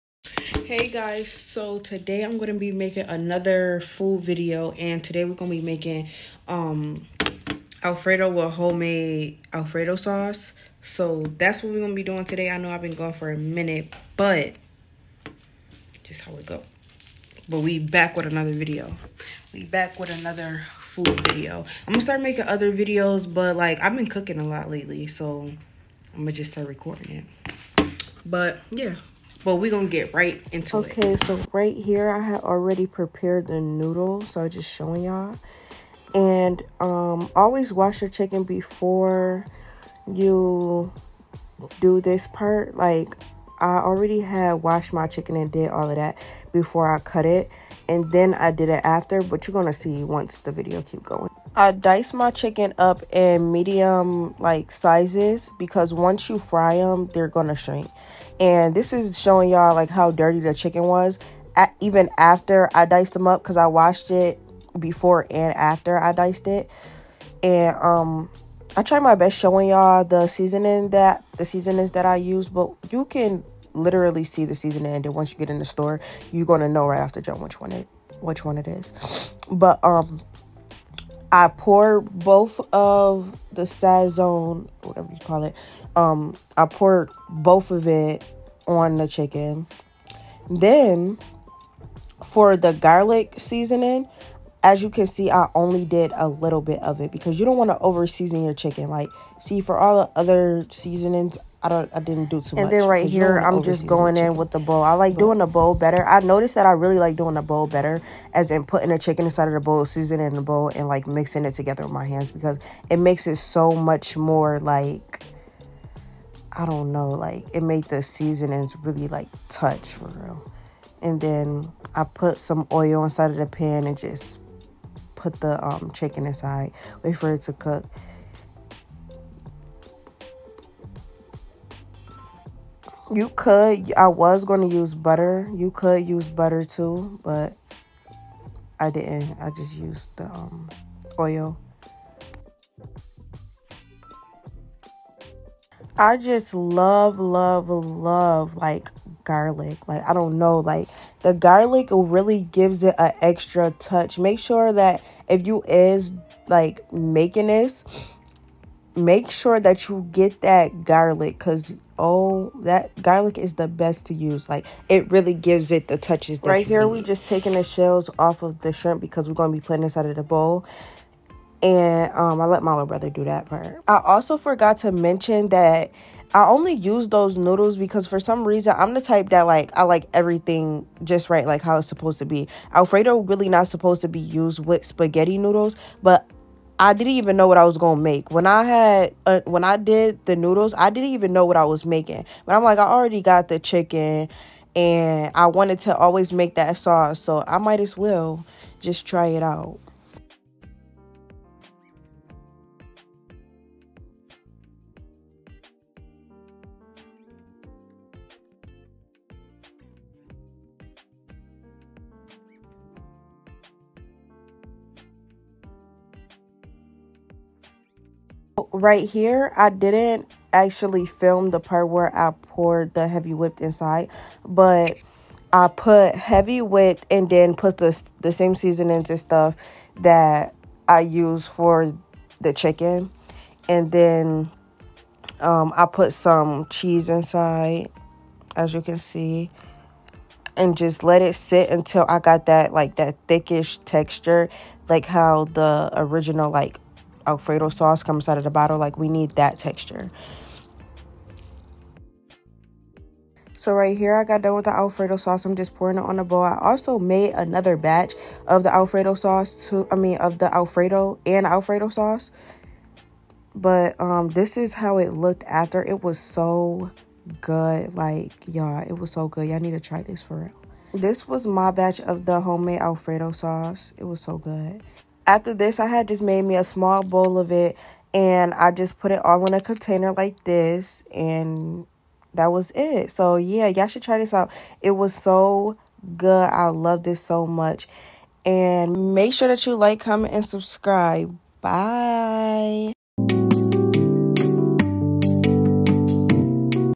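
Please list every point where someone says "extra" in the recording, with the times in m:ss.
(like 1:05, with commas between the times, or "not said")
2:33.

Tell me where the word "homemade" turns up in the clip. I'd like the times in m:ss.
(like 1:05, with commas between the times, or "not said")
0:08, 4:32.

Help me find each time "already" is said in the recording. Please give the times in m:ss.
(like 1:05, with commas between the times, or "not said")
0:32, 0:43, 3:12.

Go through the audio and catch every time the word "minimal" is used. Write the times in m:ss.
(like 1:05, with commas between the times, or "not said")
not said.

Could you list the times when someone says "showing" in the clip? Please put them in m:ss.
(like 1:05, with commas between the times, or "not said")
0:34, 0:59, 1:09.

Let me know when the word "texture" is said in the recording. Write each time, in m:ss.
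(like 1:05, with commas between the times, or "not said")
4:03, 4:09.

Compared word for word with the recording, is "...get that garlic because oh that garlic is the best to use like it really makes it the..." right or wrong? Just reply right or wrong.
wrong.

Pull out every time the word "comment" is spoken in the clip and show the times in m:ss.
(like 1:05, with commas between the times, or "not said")
4:49.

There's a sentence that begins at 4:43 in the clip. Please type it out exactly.
So yeah, y'all should try this out.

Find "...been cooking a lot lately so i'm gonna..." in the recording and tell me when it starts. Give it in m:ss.
0:23.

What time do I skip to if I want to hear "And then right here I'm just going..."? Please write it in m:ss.
1:42.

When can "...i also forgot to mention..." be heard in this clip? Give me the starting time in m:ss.
2:53.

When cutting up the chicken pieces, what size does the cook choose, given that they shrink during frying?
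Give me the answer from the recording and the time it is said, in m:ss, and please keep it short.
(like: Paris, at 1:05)
Medium, at 0:53.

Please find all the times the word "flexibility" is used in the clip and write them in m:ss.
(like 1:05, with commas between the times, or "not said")
not said.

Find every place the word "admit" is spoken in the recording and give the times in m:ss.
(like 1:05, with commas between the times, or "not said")
not said.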